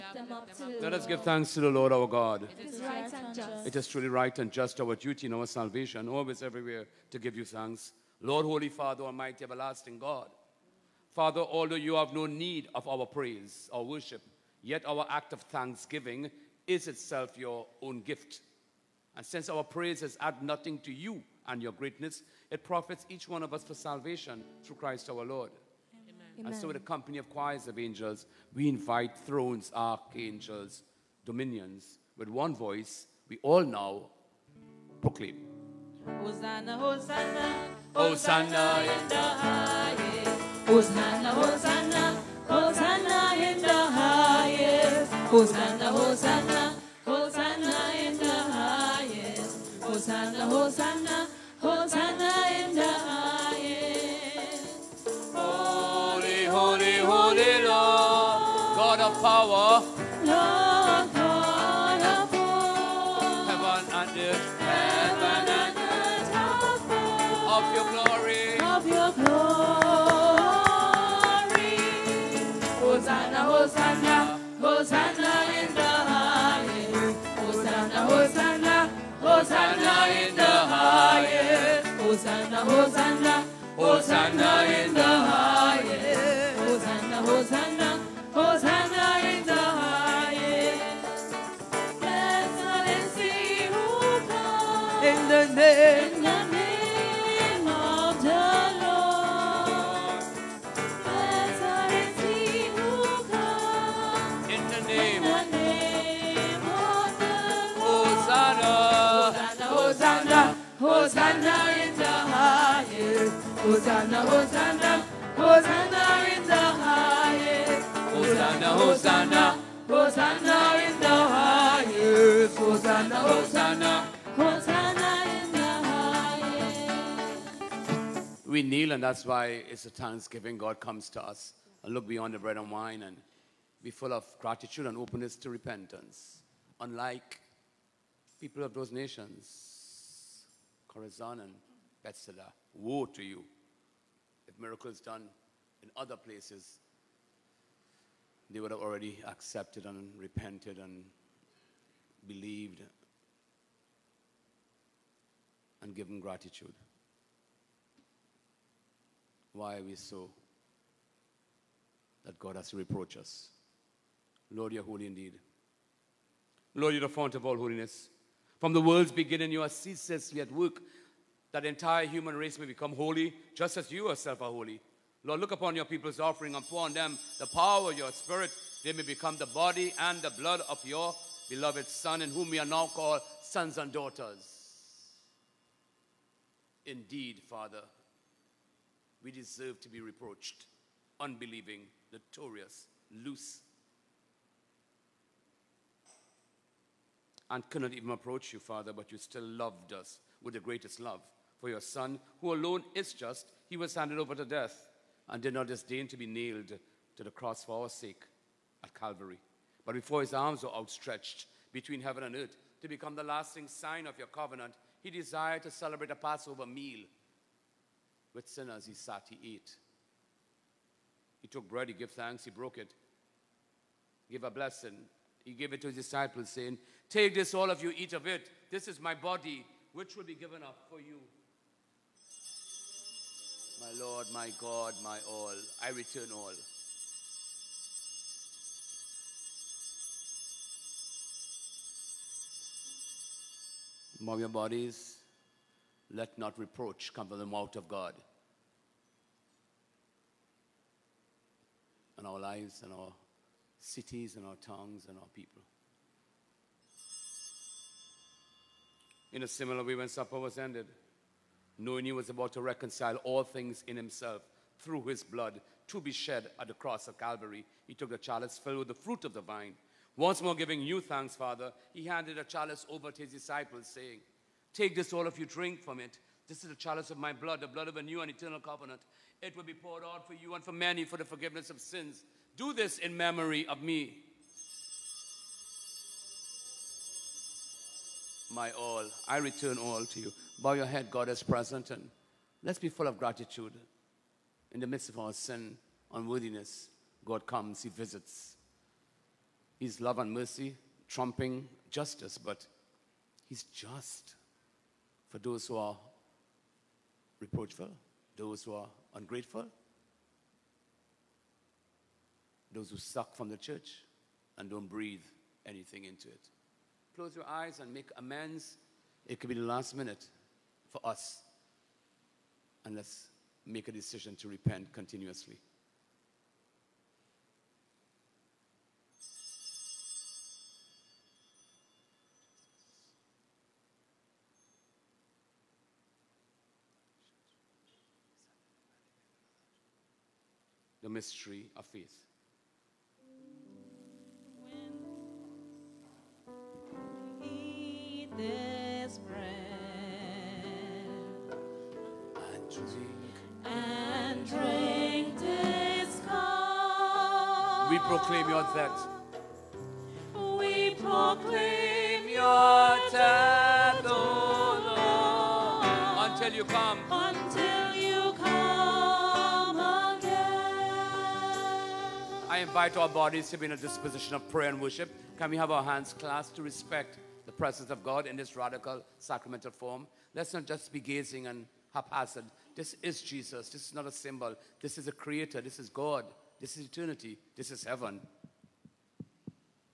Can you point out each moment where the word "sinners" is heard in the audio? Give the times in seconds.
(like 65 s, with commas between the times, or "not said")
218 s.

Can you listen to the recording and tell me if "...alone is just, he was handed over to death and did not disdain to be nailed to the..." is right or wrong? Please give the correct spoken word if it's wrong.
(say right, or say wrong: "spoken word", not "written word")
right.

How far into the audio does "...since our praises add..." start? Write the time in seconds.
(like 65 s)
19 s.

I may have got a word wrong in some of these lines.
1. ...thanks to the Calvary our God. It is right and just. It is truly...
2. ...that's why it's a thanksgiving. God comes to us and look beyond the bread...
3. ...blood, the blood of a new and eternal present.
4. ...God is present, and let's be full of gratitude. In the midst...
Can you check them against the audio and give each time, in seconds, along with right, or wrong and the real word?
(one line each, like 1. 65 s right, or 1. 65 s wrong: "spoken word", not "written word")
1. 1 s wrong: "Lord", not "Calvary"
2. 129 s right
3. 277 s wrong: "covenant", not "present"
4. 291 s right.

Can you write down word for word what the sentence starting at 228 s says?
This is my body, which will be given up for you.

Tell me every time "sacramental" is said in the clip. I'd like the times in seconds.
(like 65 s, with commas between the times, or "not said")
379 s.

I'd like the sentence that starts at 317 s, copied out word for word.
Close your eyes and make amends.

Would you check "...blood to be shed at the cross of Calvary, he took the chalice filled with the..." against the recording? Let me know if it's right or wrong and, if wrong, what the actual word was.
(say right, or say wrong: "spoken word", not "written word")
right.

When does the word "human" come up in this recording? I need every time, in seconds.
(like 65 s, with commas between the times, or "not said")
172 s.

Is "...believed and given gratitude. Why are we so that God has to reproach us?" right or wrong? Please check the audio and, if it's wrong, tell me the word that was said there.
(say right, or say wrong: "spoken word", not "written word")
right.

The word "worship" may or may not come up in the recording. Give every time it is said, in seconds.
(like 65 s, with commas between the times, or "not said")
13 s, 374 s.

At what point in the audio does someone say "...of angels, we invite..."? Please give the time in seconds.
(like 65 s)
27 s.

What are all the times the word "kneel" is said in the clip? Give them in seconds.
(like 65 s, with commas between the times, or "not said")
128 s.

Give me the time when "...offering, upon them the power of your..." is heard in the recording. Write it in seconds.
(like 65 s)
176 s.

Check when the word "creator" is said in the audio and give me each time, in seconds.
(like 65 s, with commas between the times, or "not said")
385 s.